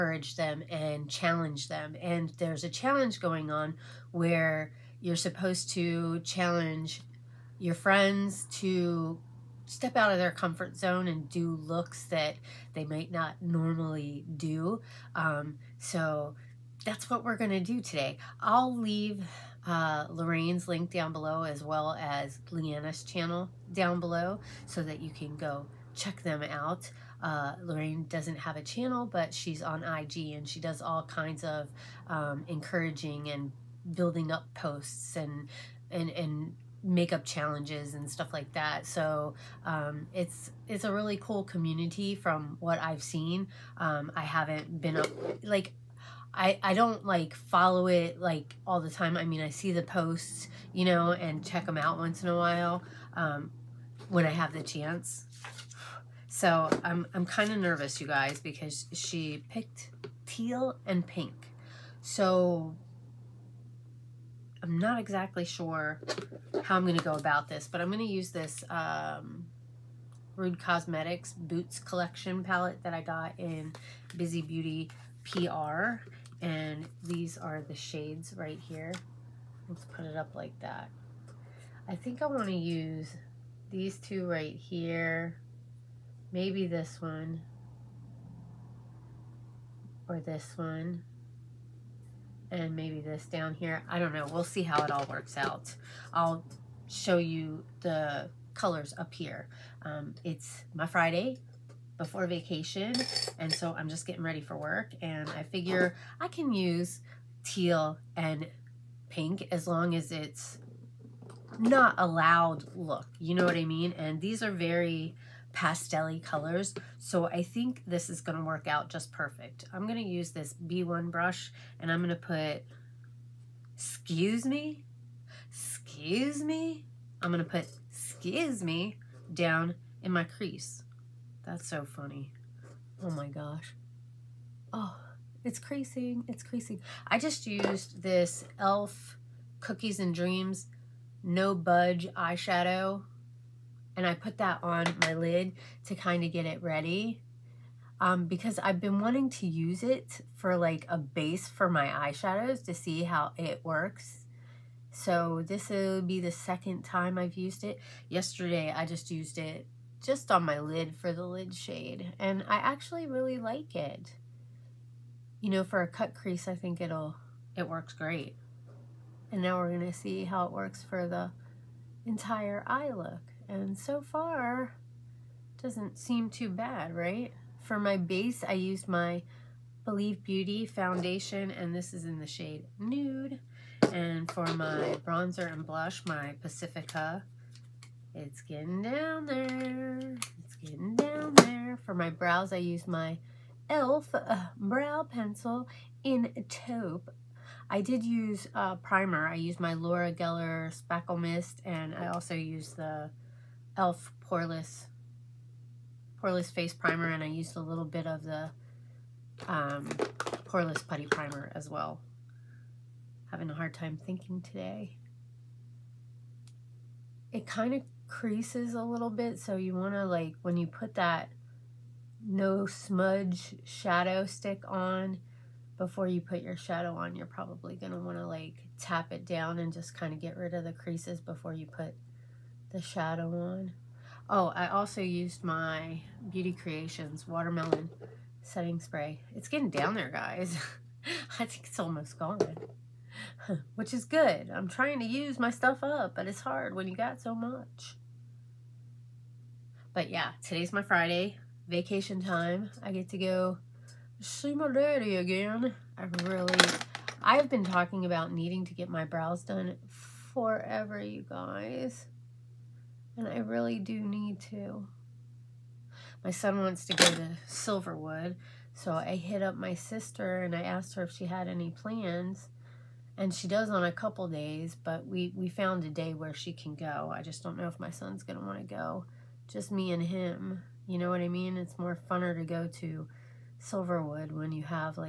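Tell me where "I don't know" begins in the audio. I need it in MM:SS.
01:33.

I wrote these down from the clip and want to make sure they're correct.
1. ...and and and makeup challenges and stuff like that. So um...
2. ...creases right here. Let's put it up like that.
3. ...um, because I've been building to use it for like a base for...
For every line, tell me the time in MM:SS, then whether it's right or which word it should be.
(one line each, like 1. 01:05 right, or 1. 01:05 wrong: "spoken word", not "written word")
1. 00:35 right
2. 01:17 wrong: "shades", not "creases"
3. 02:28 wrong: "wanting", not "building".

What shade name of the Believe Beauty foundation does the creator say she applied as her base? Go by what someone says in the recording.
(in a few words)
Nude.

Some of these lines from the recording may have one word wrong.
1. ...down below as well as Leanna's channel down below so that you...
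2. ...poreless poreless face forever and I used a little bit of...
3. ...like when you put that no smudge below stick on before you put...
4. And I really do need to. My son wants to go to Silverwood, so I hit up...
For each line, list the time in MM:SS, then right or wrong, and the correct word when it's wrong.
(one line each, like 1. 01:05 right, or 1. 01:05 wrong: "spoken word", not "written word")
1. 00:20 right
2. 03:24 wrong: "primer", not "forever"
3. 03:40 wrong: "shadow", not "below"
4. 04:23 right.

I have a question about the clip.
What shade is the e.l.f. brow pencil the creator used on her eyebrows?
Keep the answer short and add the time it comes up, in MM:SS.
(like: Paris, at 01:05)
Taupe, at 03:16.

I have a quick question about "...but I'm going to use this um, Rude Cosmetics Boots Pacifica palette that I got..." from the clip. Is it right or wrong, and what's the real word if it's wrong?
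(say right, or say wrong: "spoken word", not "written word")
wrong: "Collection", not "Pacifica".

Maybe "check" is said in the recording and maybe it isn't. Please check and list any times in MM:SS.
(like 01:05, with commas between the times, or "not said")
00:25, 00:51.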